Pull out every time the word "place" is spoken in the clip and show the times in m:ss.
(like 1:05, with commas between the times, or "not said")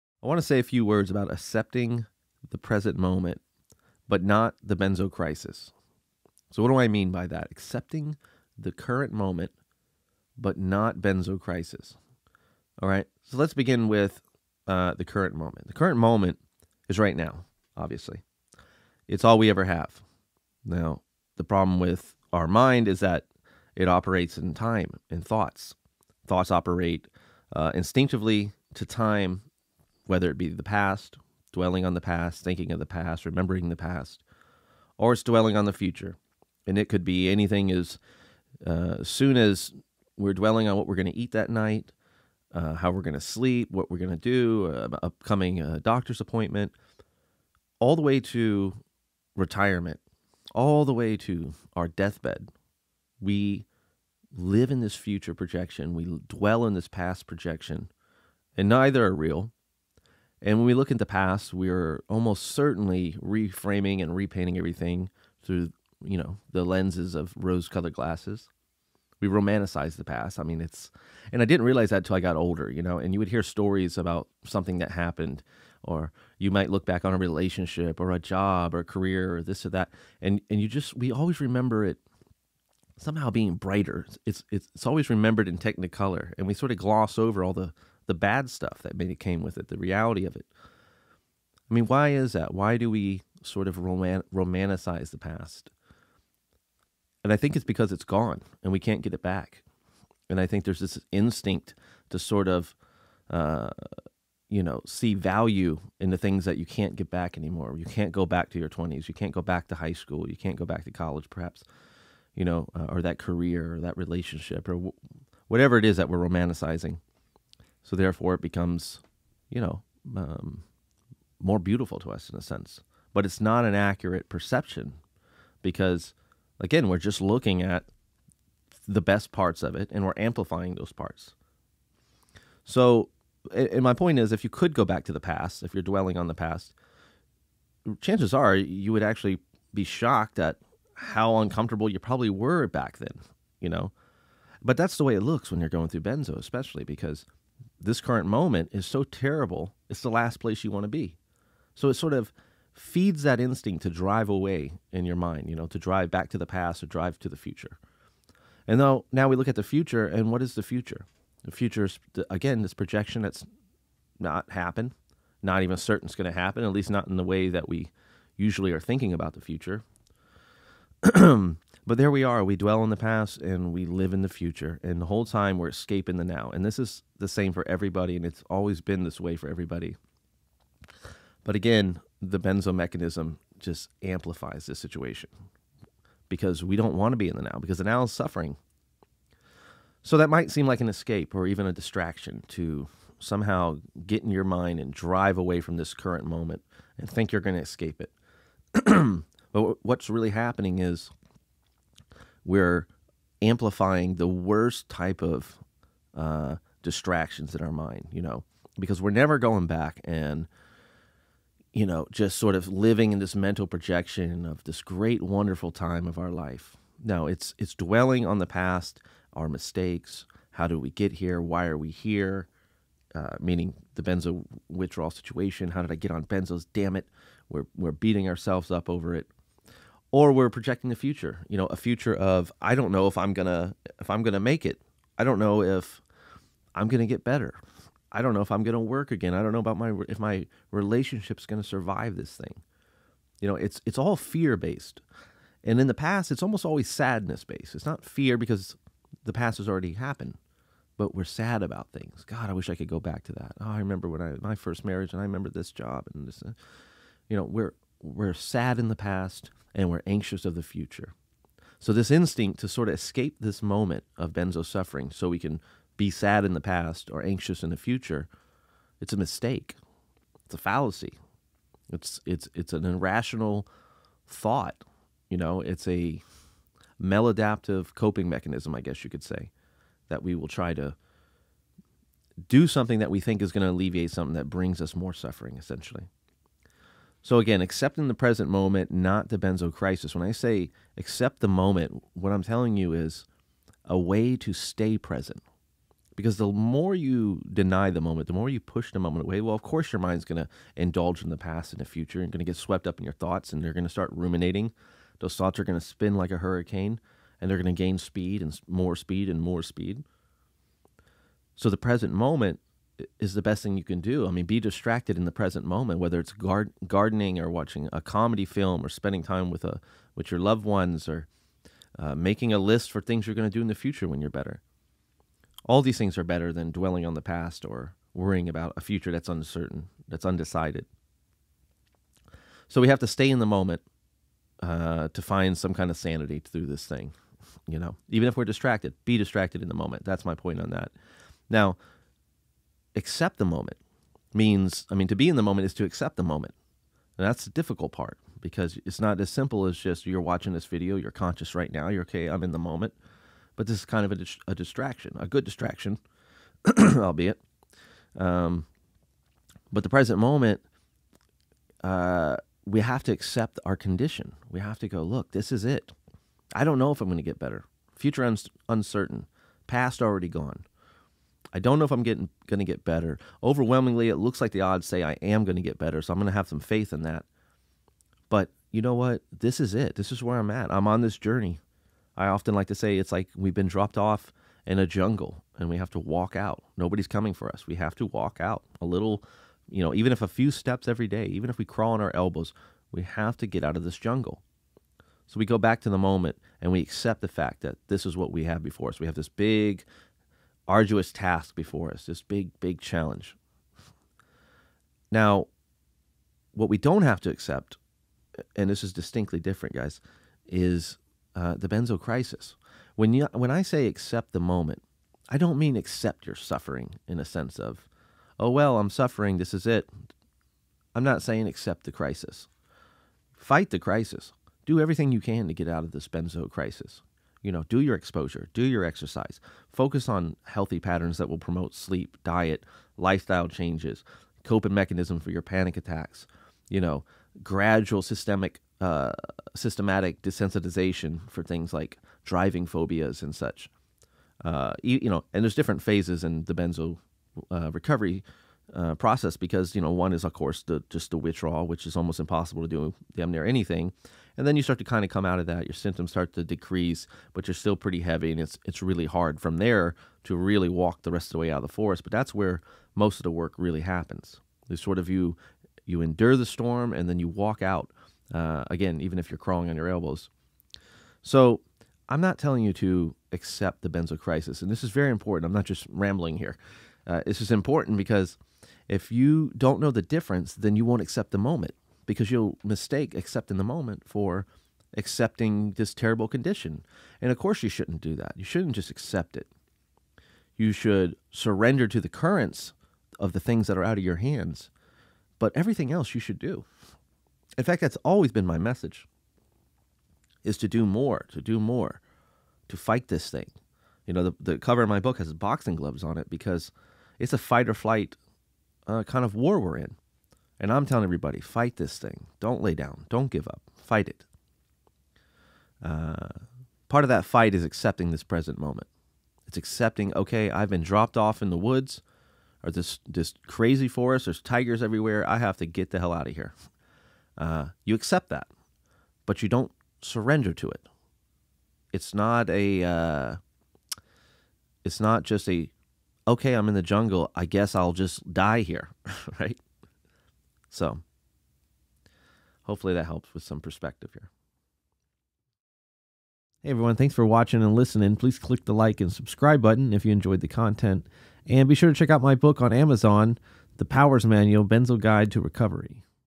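2:30.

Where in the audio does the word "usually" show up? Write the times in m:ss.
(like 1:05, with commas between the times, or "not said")
2:48.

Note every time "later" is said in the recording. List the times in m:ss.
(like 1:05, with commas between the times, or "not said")
not said.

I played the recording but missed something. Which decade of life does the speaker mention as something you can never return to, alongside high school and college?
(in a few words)
your 20s.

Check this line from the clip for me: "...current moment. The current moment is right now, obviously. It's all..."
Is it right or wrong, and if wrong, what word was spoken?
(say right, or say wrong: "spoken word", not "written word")
right.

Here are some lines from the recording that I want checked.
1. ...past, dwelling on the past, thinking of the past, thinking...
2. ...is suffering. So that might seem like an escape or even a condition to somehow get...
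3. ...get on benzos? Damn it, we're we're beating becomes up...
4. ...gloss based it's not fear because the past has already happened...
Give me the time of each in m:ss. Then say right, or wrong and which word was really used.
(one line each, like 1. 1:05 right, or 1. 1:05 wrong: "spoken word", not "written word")
1. 0:30 wrong: "remembering", not "thinking"
2. 3:08 wrong: "distraction", not "condition"
3. 3:45 wrong: "ourselves", not "becomes"
4. 4:06 wrong: "sadness", not "gloss".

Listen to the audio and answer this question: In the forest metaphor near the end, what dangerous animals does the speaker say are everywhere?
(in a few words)
tigers.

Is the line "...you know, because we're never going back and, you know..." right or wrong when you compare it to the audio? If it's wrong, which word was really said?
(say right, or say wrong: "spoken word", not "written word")
right.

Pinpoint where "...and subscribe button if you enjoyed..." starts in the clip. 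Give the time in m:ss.
9:09.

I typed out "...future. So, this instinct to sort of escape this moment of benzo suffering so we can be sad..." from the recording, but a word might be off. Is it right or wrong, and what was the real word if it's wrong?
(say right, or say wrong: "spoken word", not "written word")
right.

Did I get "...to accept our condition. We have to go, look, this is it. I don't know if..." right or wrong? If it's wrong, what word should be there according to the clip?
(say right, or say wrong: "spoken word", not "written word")
right.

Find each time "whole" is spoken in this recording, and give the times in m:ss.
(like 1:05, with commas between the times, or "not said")
2:55.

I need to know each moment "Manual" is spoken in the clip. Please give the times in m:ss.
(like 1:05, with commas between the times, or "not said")
9:14.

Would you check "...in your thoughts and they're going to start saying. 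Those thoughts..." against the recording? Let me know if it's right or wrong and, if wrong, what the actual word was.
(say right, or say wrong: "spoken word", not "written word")
wrong: "ruminating", not "saying".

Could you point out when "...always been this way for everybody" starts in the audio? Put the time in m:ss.
2:58.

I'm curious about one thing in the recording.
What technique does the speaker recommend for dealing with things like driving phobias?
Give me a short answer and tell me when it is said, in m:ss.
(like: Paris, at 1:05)
systematic desensitization, at 7:19.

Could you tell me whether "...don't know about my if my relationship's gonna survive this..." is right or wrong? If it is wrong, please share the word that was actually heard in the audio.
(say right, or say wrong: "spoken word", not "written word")
right.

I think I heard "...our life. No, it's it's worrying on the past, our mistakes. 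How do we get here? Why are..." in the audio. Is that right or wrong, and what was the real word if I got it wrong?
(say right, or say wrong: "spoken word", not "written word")
wrong: "dwelling", not "worrying".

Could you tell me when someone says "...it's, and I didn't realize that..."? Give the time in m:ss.
1:10.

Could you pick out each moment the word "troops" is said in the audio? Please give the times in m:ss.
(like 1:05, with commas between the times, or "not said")
not said.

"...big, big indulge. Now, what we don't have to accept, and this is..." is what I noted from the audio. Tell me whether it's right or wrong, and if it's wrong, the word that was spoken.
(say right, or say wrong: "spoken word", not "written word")
wrong: "challenge", not "indulge".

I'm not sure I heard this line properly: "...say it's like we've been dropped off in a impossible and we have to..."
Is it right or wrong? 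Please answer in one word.
wrong.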